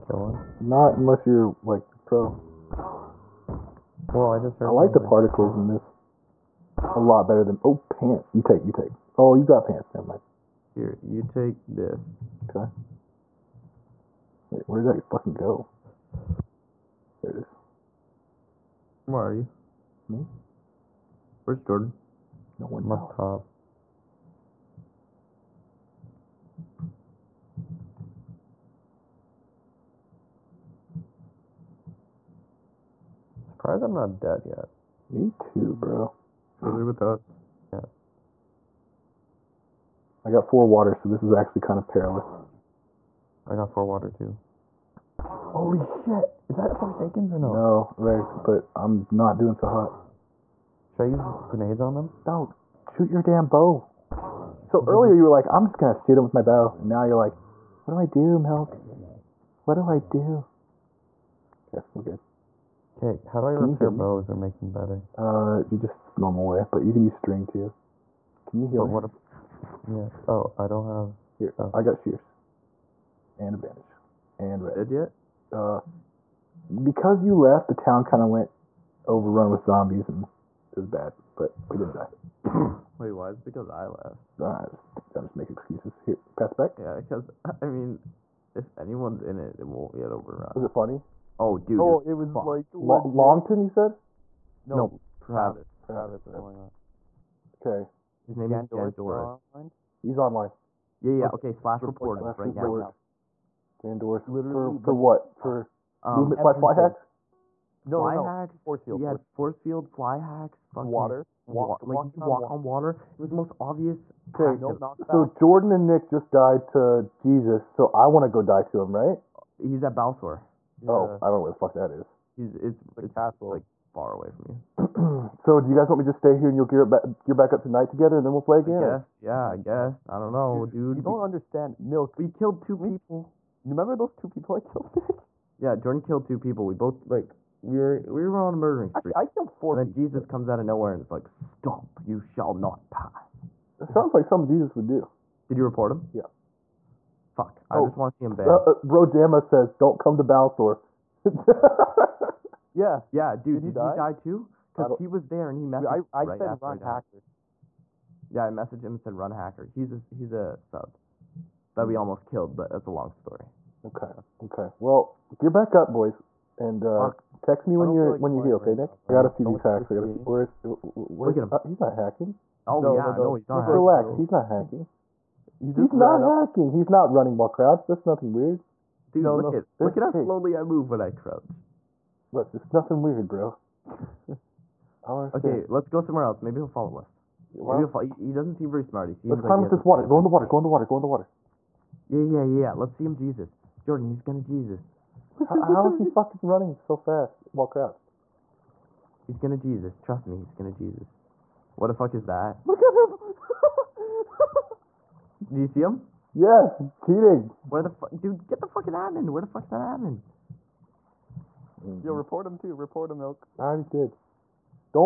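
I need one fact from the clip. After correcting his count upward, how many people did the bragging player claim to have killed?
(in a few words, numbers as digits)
4.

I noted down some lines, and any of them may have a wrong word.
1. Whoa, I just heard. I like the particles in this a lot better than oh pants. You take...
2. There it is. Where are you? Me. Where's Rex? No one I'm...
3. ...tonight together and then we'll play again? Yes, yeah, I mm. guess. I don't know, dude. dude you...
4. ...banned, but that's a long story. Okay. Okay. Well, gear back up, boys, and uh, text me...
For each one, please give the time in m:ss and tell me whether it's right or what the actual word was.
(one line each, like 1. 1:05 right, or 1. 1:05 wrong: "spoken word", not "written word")
1. 0:04 right
2. 0:17 wrong: "Jordan", not "Rex"
3. 2:07 right
4. 2:42 wrong: "killed", not "banned".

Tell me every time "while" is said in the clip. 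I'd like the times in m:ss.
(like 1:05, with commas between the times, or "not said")
2:57, 3:17.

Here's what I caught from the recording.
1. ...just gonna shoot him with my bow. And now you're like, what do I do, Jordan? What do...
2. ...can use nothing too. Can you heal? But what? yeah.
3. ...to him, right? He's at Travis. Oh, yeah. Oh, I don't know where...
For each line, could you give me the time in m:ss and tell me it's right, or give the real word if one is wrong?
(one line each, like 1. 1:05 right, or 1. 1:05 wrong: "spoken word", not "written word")
1. 0:55 wrong: "Milk", not "Jordan"
2. 1:06 wrong: "string", not "nothing"
3. 1:58 wrong: "Balsor", not "Travis".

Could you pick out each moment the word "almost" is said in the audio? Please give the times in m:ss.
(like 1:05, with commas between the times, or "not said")
2:41.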